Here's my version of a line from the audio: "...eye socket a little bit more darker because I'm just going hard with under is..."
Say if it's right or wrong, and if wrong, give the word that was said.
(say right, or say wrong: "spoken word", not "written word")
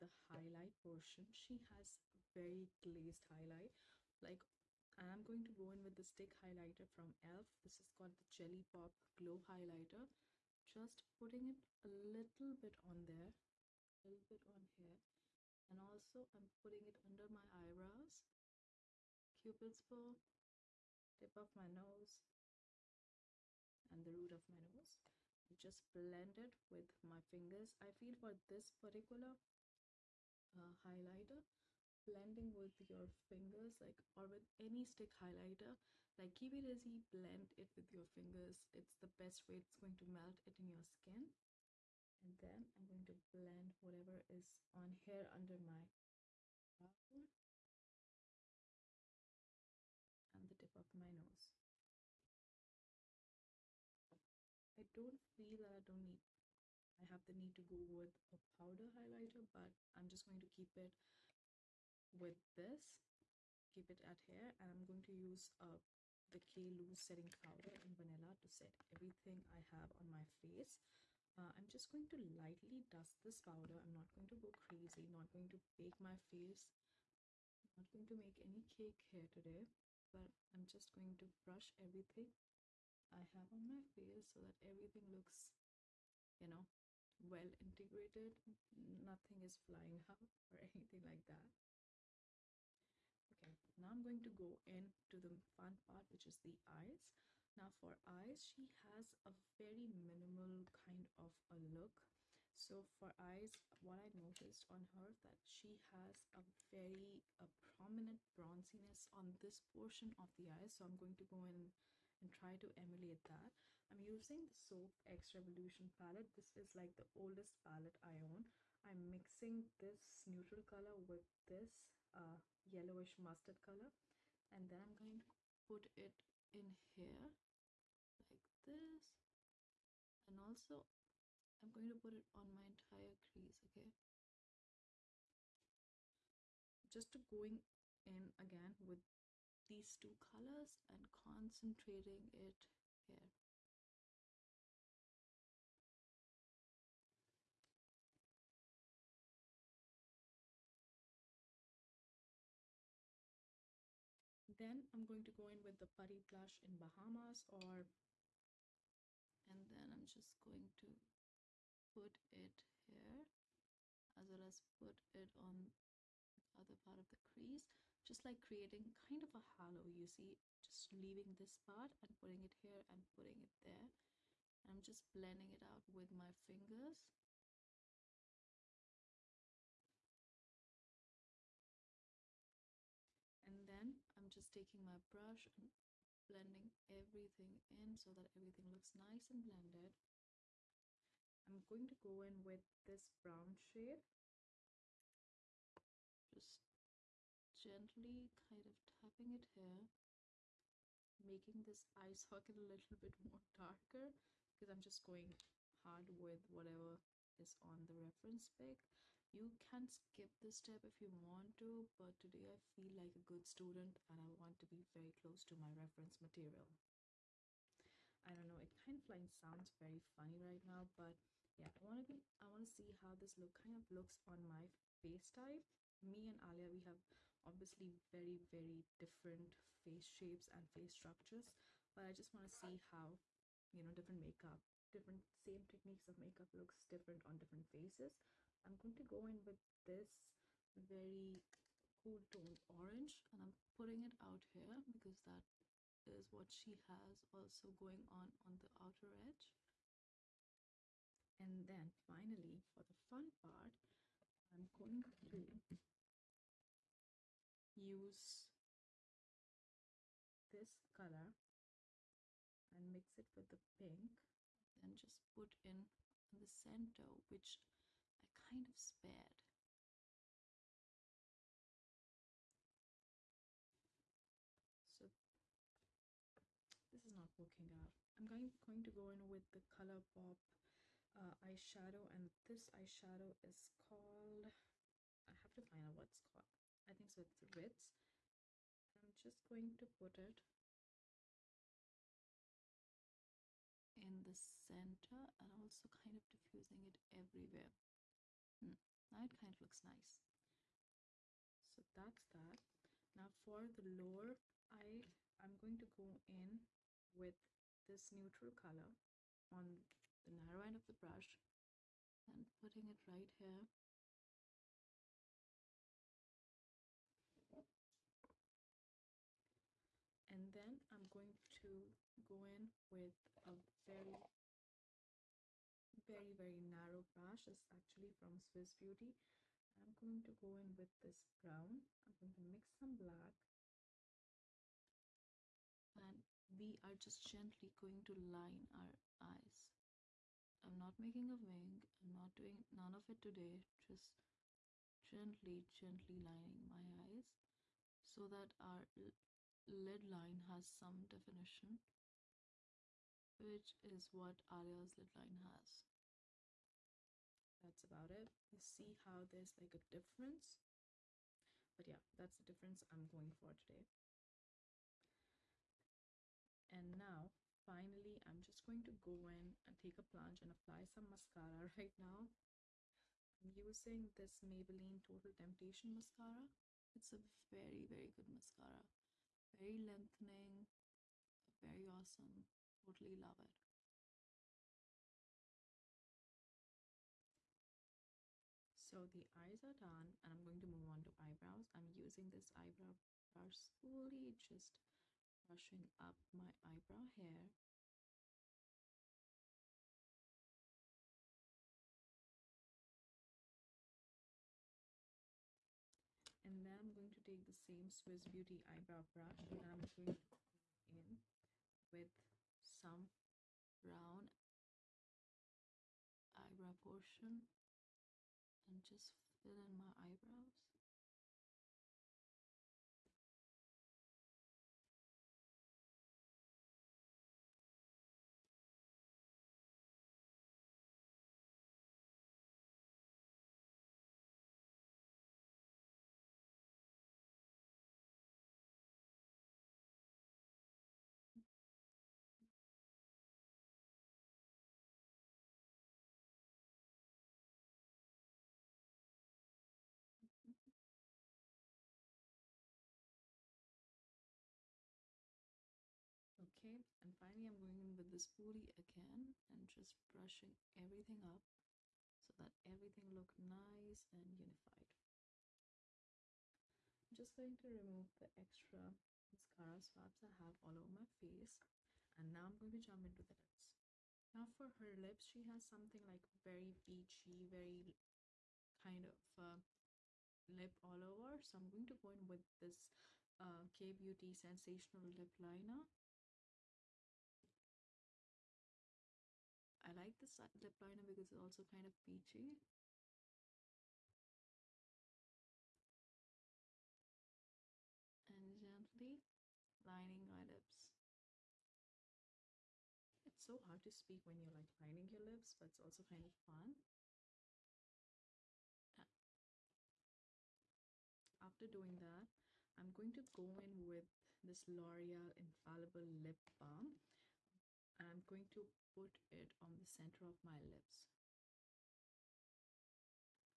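wrong: "whatever", not "under".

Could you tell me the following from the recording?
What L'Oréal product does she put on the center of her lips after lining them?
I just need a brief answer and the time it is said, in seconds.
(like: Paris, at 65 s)
Infallible lip balm, at 515 s.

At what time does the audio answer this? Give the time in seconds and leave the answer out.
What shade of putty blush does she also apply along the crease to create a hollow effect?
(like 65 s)
156 s.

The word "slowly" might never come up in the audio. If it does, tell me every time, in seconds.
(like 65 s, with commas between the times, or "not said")
393 s.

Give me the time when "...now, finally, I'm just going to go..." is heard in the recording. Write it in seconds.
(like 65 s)
366 s.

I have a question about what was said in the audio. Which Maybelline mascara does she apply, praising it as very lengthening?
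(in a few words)
Total Temptation.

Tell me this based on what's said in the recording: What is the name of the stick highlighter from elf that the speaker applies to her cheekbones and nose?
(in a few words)
Jelly Pop Glow Highlighter.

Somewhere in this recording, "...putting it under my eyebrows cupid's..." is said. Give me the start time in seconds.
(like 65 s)
16 s.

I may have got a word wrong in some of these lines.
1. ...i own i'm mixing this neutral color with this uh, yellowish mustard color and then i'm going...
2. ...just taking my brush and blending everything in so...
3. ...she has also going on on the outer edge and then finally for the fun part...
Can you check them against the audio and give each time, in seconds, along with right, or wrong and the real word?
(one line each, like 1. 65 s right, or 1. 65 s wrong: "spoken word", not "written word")
1. 118 s right
2. 184 s right
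3. 246 s right.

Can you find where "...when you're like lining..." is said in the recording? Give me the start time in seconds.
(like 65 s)
504 s.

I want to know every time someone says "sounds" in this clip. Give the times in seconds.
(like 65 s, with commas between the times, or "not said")
219 s.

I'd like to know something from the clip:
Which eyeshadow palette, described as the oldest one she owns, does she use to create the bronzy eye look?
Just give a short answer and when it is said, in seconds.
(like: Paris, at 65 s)
Soph x Revolution, at 114 s.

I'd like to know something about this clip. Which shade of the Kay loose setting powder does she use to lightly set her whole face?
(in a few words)
Vanilla.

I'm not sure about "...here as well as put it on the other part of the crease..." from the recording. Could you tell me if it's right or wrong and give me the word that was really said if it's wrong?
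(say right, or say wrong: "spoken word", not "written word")
right.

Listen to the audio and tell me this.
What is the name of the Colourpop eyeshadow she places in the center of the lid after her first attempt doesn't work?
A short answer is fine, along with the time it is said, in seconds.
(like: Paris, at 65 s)
Ritz, at 287 s.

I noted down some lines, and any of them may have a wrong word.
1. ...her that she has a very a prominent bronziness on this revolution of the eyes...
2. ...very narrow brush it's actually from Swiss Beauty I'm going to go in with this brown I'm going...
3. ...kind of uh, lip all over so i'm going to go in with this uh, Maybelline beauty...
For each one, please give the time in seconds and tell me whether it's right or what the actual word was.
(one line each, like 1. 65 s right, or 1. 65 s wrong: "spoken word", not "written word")
1. 104 s wrong: "portion", not "revolution"
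2. 326 s right
3. 478 s wrong: "Kay", not "Maybelline".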